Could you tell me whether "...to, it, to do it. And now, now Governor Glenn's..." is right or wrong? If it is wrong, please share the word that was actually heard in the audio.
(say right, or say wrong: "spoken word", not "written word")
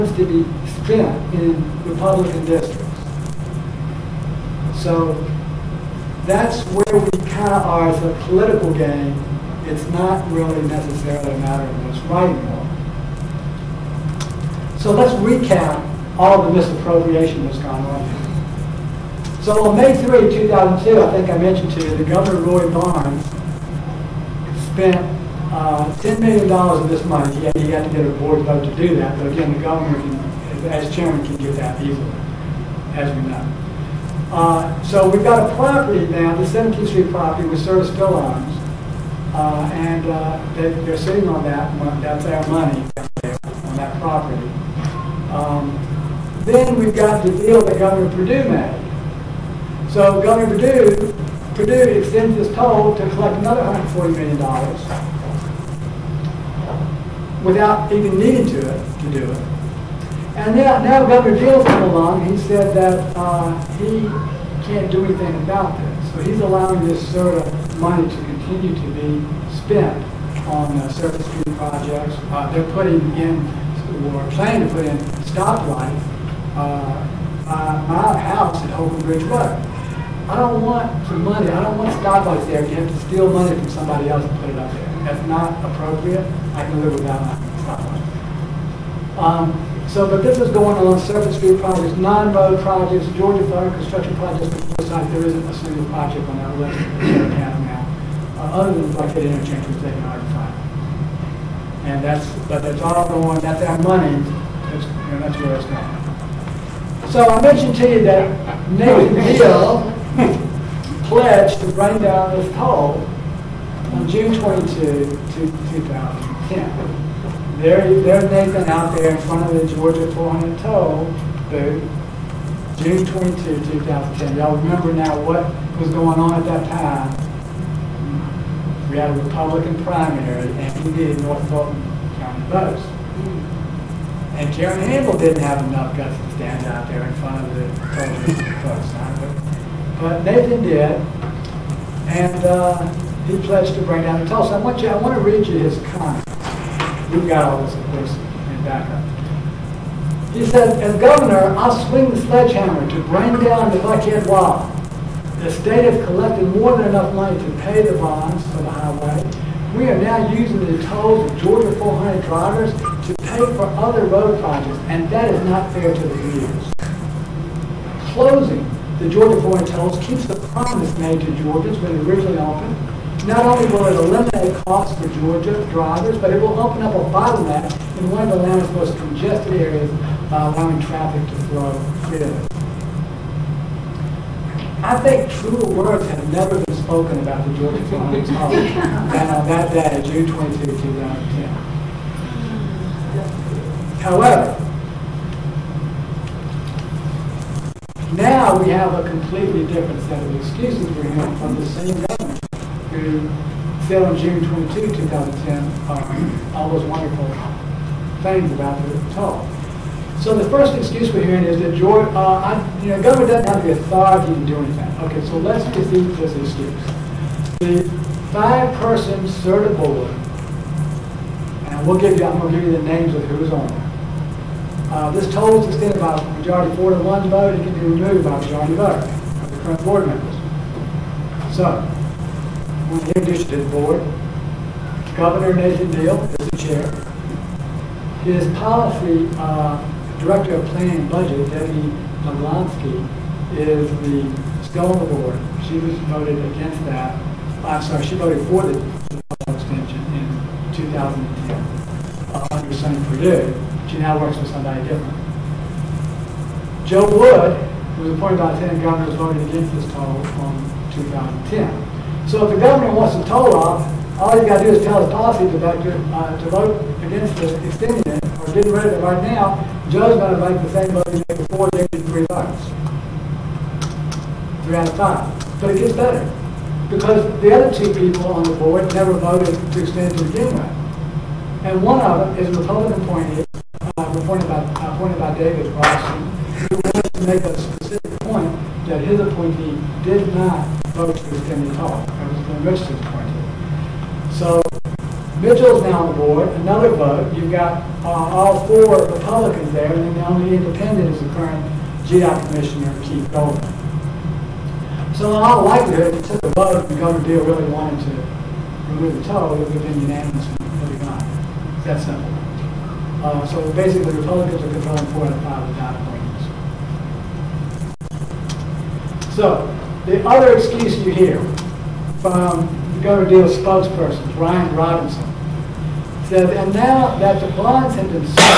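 wrong: "Deal", not "Glenn".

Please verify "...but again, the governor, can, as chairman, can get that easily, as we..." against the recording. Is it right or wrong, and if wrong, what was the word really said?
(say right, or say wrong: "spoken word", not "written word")
right.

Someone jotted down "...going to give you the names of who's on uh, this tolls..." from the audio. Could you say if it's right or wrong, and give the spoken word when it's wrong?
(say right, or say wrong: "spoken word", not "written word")
right.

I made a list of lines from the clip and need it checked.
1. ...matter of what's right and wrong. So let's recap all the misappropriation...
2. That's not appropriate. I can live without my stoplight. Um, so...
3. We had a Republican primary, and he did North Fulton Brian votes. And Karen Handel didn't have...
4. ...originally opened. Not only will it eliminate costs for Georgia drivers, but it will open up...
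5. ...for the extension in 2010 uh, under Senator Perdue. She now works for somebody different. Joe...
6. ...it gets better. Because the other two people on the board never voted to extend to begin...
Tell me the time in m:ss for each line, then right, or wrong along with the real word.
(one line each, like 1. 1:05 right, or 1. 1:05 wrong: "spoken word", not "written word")
1. 0:11 right
2. 1:25 right
3. 2:08 wrong: "County", not "Brian"
4. 2:52 right
5. 4:08 right
6. 4:35 right.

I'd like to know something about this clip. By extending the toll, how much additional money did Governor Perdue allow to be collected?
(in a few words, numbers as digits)
$140 million.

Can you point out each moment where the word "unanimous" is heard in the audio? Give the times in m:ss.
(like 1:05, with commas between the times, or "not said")
5:10.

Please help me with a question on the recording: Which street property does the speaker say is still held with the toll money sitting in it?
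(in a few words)
17th Street.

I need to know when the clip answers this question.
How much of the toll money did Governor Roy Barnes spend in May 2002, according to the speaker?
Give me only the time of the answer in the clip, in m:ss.
0:25.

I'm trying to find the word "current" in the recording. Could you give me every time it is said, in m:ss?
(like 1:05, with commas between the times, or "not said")
3:49, 5:01.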